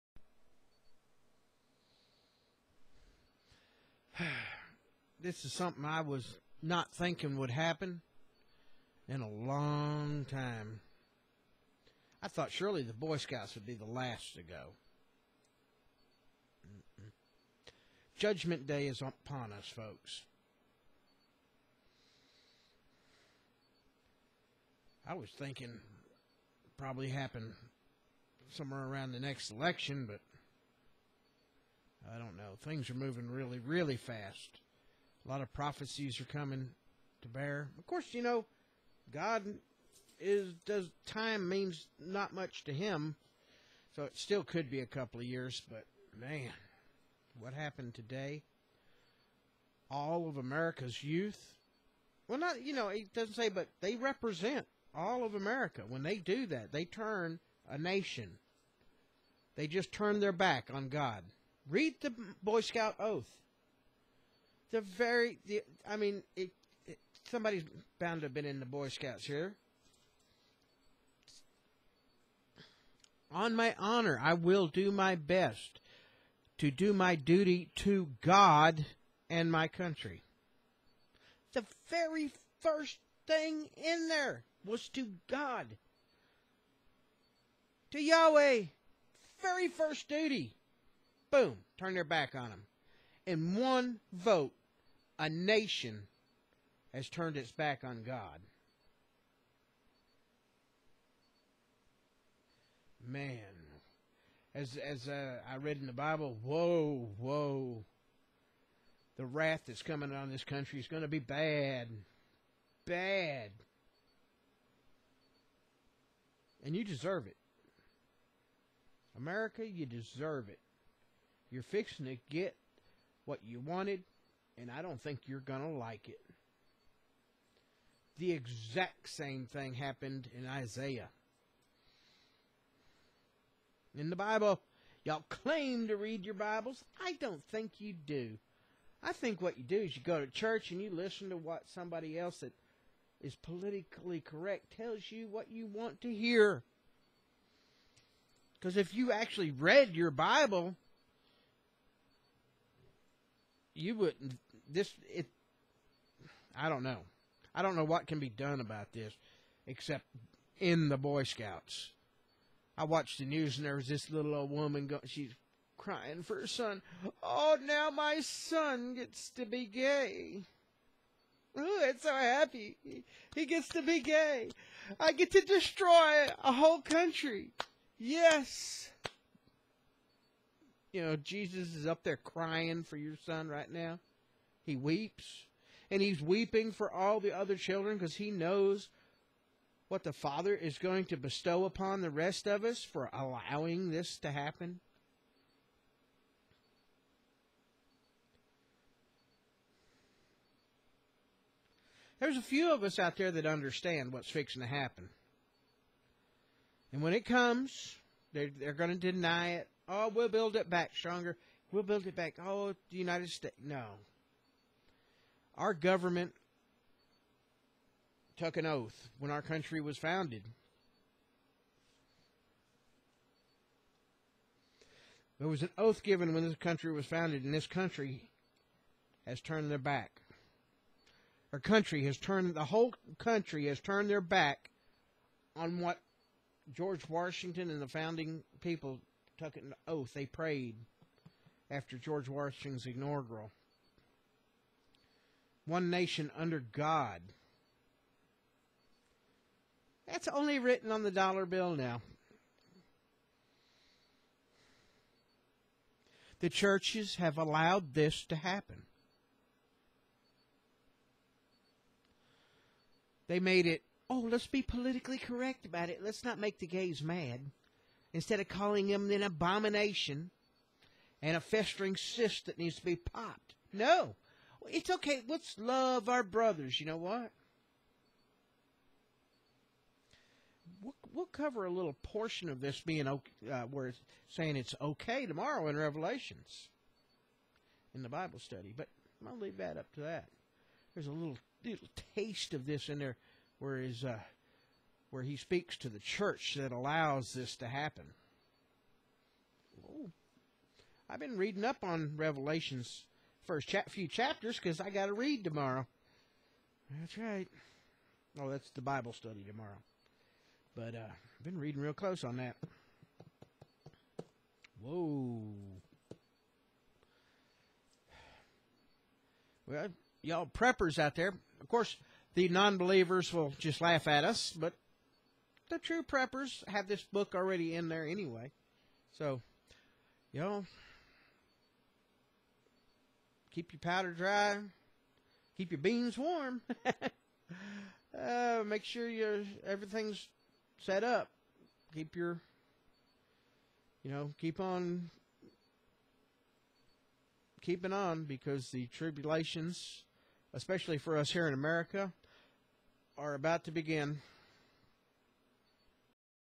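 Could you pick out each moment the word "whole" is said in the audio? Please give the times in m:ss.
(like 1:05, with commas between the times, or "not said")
2:56, 3:52.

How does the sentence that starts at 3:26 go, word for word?
And when it comes, they're, they're going to deny it.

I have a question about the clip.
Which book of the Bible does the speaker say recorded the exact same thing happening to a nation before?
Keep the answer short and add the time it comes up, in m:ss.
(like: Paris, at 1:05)
Isaiah, at 2:10.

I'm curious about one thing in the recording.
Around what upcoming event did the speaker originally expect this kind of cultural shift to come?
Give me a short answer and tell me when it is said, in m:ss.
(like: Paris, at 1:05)
the next election, at 0:29.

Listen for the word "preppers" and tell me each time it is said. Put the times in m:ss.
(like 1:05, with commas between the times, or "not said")
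5:20, 5:26.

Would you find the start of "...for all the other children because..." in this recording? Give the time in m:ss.
3:06.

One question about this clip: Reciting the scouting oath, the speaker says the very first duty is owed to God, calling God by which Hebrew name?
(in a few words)
Yahweh.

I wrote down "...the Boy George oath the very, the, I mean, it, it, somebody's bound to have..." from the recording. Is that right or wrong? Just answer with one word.
wrong.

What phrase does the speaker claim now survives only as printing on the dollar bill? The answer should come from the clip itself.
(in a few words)
One nation under God.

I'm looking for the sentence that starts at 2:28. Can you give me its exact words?
Because if you actually read your Bible, you wouldn't this it I don't know.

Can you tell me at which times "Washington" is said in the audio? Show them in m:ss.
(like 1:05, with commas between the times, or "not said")
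3:57, 4:02.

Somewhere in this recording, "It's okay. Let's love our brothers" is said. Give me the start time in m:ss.
4:34.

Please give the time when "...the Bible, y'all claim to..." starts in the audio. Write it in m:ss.
2:14.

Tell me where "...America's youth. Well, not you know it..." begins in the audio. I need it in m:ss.
0:50.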